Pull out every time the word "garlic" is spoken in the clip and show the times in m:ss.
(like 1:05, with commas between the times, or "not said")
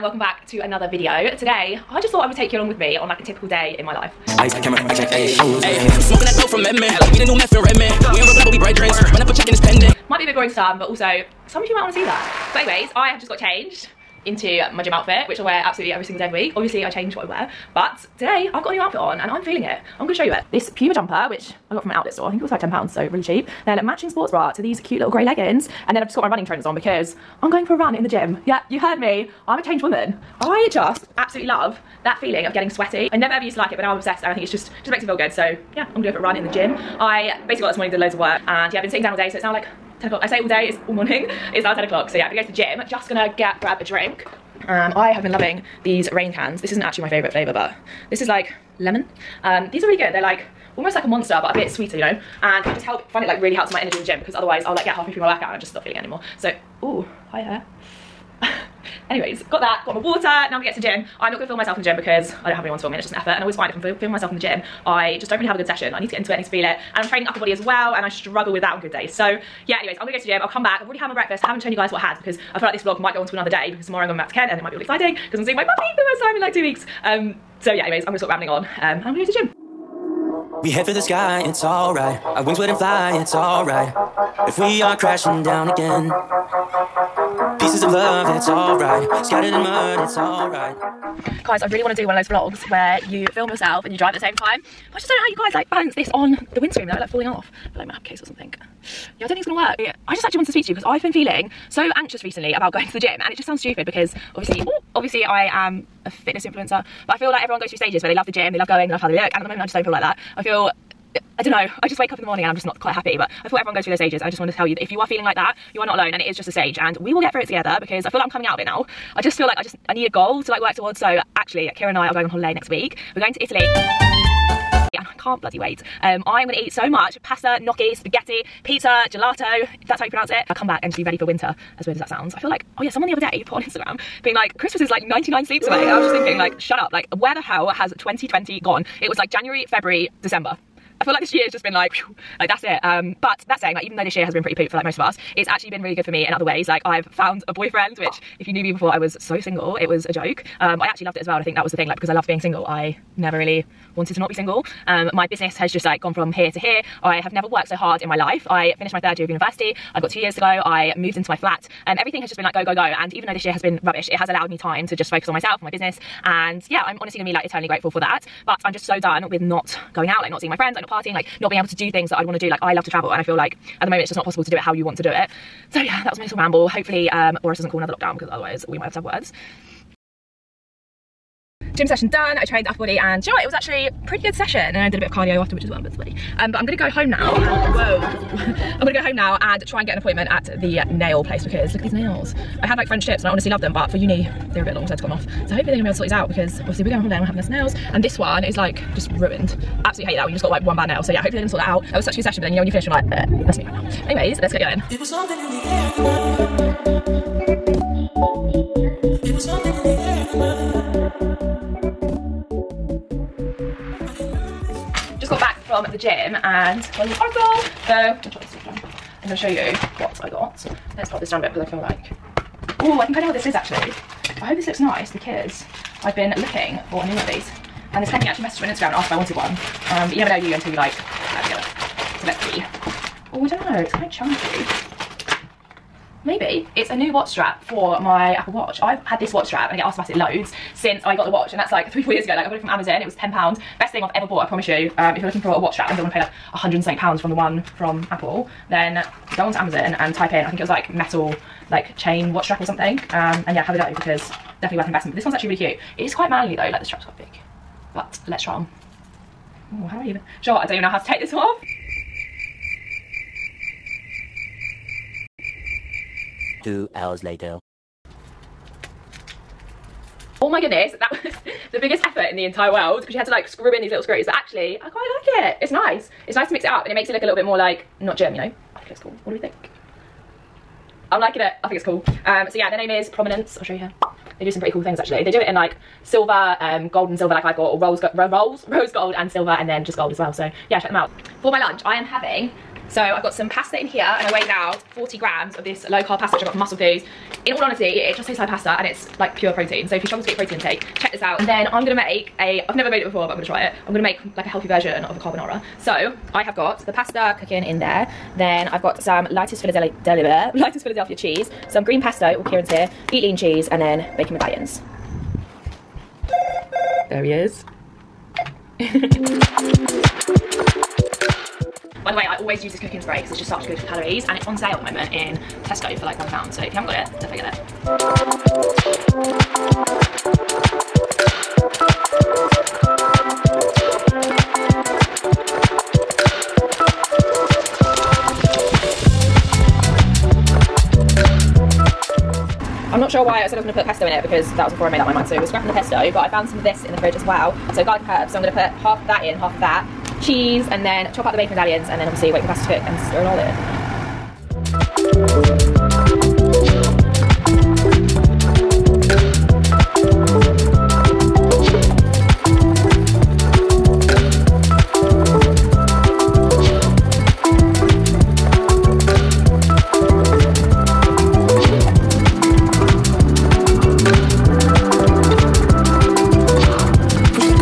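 5:47.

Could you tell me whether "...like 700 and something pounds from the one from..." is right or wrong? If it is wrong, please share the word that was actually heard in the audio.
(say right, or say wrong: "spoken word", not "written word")
wrong: "100", not "700".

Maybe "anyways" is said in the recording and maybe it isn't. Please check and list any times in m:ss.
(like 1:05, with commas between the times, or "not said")
0:12, 0:59, 1:09, 1:17, 3:24.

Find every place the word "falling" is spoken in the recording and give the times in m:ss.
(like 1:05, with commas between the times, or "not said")
1:37.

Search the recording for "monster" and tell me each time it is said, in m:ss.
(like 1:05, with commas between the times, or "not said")
0:51.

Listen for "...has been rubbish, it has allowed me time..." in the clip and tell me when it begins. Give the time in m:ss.
2:43.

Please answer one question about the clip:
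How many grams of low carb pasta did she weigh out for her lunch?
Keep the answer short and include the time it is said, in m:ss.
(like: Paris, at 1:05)
40 grams, at 4:54.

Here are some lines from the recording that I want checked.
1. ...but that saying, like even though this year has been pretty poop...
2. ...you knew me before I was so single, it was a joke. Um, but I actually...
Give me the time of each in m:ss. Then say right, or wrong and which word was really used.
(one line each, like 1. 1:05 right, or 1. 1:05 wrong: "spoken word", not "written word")
1. 2:23 right
2. 2:28 right.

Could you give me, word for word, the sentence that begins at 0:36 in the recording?
I basically got this morning, did loads of work and yeah, I've been sitting down all day.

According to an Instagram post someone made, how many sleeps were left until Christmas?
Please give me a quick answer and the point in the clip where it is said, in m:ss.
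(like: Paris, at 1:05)
99, at 2:15.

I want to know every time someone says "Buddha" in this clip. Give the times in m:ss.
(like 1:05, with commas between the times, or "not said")
not said.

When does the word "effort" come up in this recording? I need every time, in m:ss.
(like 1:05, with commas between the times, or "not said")
1:03, 4:32.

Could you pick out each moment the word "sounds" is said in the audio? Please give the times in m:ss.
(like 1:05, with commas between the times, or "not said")
1:43, 2:12.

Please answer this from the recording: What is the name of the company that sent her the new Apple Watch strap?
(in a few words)
Prominence.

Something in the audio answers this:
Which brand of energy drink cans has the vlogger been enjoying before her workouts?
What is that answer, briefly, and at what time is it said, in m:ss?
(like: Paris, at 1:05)
Reign, at 0:46.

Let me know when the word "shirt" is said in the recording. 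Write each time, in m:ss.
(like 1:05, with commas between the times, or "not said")
not said.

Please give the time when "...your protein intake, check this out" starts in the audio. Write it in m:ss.
5:00.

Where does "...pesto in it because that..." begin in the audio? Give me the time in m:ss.
5:43.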